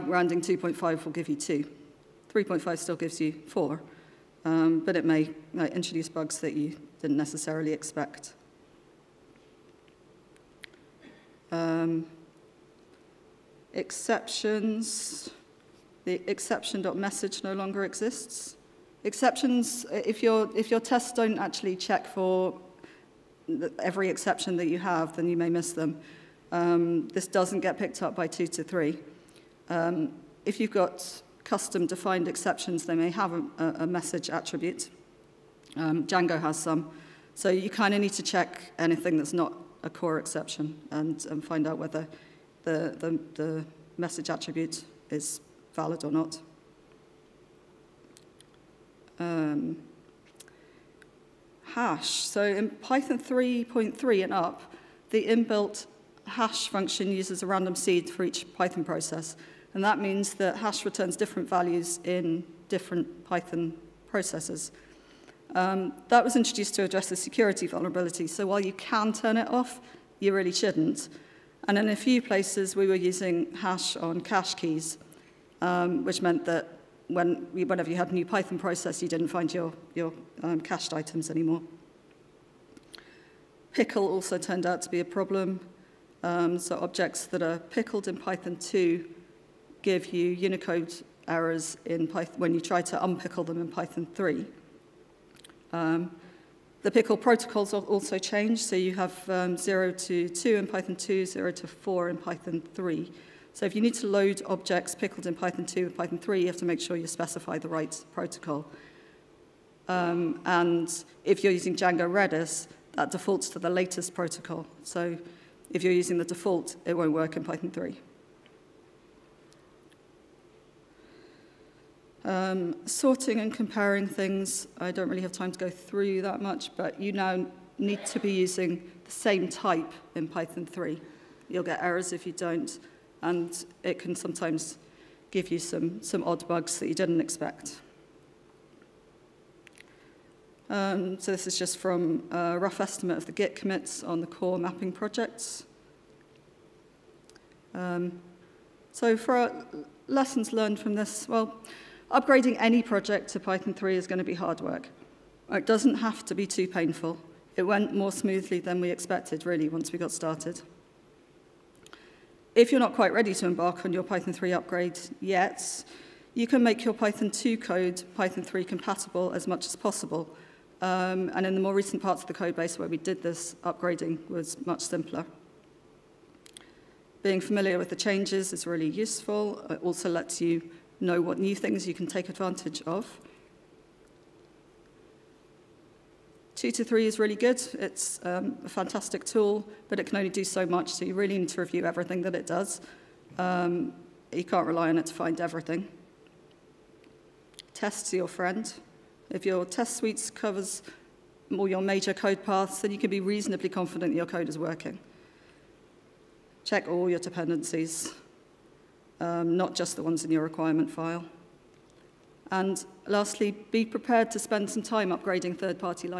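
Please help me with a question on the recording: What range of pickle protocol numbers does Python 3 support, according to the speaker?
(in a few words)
0 to 4.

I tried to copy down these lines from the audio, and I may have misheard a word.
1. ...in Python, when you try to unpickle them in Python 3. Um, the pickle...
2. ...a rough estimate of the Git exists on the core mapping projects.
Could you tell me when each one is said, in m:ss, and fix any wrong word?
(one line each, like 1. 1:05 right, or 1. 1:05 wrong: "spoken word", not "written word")
1. 1:31 right
2. 2:22 wrong: "commits", not "exists".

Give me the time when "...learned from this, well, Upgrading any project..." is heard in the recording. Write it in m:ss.
2:30.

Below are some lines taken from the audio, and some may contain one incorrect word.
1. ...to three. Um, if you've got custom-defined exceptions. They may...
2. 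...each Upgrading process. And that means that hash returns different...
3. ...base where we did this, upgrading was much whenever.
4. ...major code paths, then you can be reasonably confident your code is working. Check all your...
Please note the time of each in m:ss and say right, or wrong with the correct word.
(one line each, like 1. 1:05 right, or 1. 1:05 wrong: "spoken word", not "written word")
1. 0:28 right
2. 0:58 wrong: "Python", not "Upgrading"
3. 2:52 wrong: "simpler", not "whenever"
4. 3:21 right.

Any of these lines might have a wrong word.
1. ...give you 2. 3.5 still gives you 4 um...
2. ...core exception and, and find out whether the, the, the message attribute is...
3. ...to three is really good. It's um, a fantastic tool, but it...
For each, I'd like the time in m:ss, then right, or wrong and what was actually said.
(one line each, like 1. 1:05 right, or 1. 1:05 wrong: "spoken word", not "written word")
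1. 0:01 right
2. 0:39 right
3. 3:06 right.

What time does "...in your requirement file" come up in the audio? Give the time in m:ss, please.
3:30.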